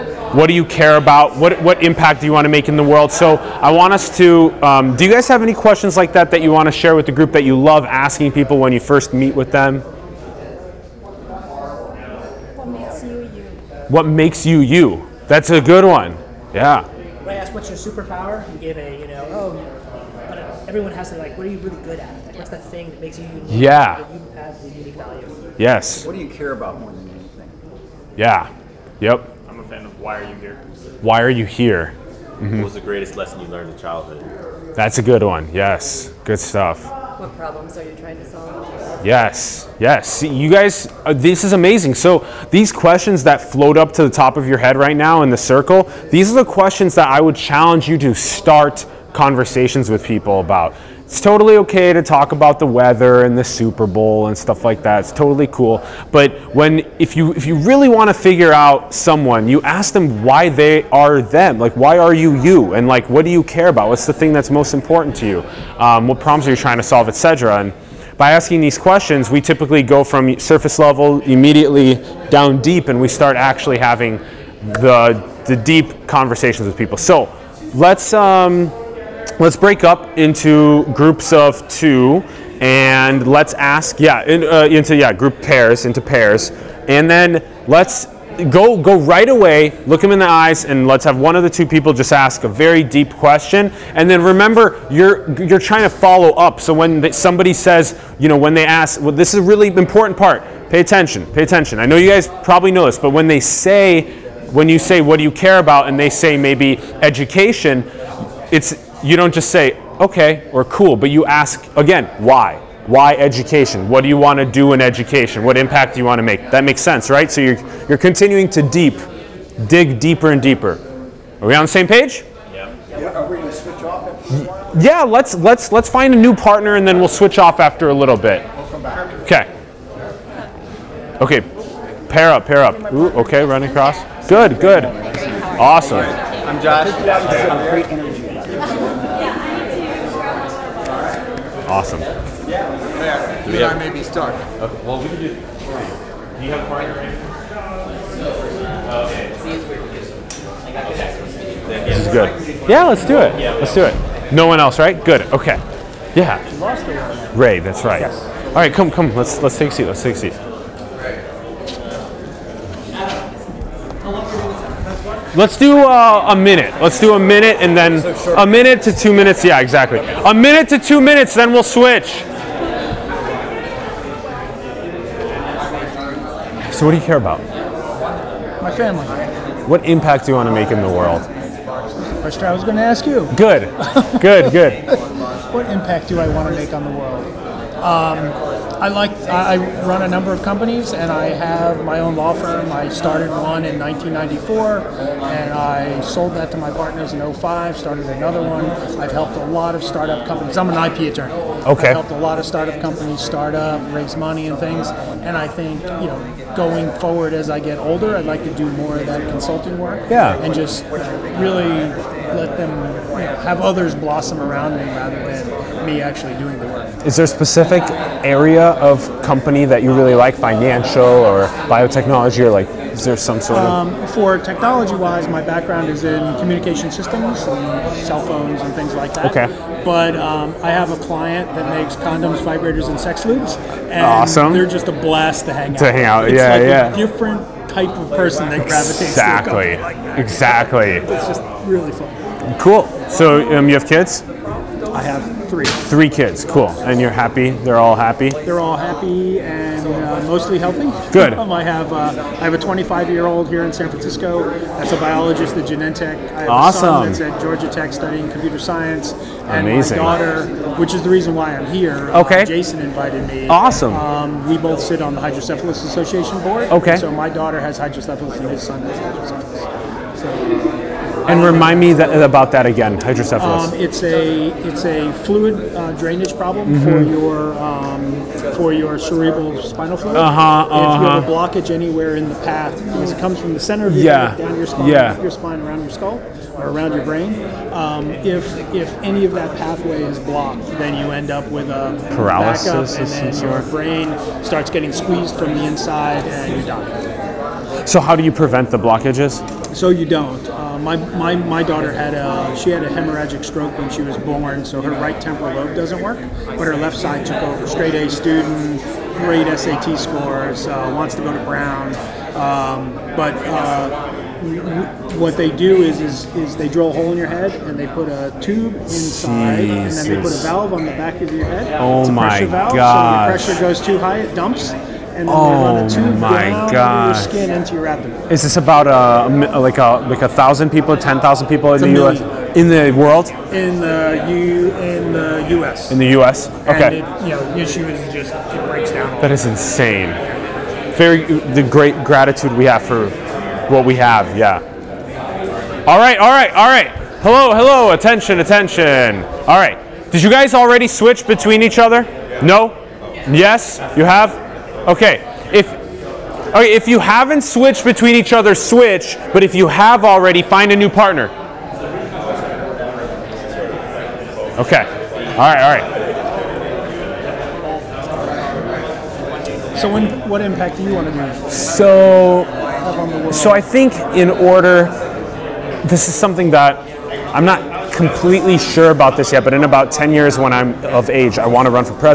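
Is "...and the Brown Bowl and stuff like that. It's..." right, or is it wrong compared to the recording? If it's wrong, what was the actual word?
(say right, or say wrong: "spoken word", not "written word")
wrong: "Super", not "Brown".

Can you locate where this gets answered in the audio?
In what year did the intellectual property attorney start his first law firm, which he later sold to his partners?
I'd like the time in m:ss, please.
3:13.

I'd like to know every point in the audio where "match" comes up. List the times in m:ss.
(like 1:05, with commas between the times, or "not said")
not said.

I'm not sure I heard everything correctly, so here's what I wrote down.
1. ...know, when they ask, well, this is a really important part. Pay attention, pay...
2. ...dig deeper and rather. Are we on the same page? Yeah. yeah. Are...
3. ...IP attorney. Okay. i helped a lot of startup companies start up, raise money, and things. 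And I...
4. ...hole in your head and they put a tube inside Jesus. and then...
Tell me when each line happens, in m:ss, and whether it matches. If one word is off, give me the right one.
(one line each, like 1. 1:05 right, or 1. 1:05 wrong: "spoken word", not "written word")
1. 1:38 right
2. 1:59 wrong: "deeper", not "rather"
3. 3:20 right
4. 5:16 right.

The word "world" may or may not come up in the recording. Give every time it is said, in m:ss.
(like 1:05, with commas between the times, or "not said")
0:02, 3:00, 3:06, 5:32.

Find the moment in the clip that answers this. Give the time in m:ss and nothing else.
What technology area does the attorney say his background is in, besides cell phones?
3:46.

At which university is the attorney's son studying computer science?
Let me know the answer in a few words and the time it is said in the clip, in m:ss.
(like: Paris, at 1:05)
Georgia Tech, at 4:17.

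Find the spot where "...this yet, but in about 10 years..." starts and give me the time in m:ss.
6:19.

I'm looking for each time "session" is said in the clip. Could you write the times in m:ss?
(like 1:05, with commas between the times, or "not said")
not said.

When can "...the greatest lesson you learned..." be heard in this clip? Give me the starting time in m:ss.
0:32.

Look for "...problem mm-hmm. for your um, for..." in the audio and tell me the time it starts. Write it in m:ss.
4:36.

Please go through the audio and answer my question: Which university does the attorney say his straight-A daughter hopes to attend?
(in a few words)
Brown.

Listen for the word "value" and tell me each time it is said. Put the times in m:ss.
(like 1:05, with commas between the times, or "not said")
0:24.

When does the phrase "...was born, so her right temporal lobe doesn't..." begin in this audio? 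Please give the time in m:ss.
5:04.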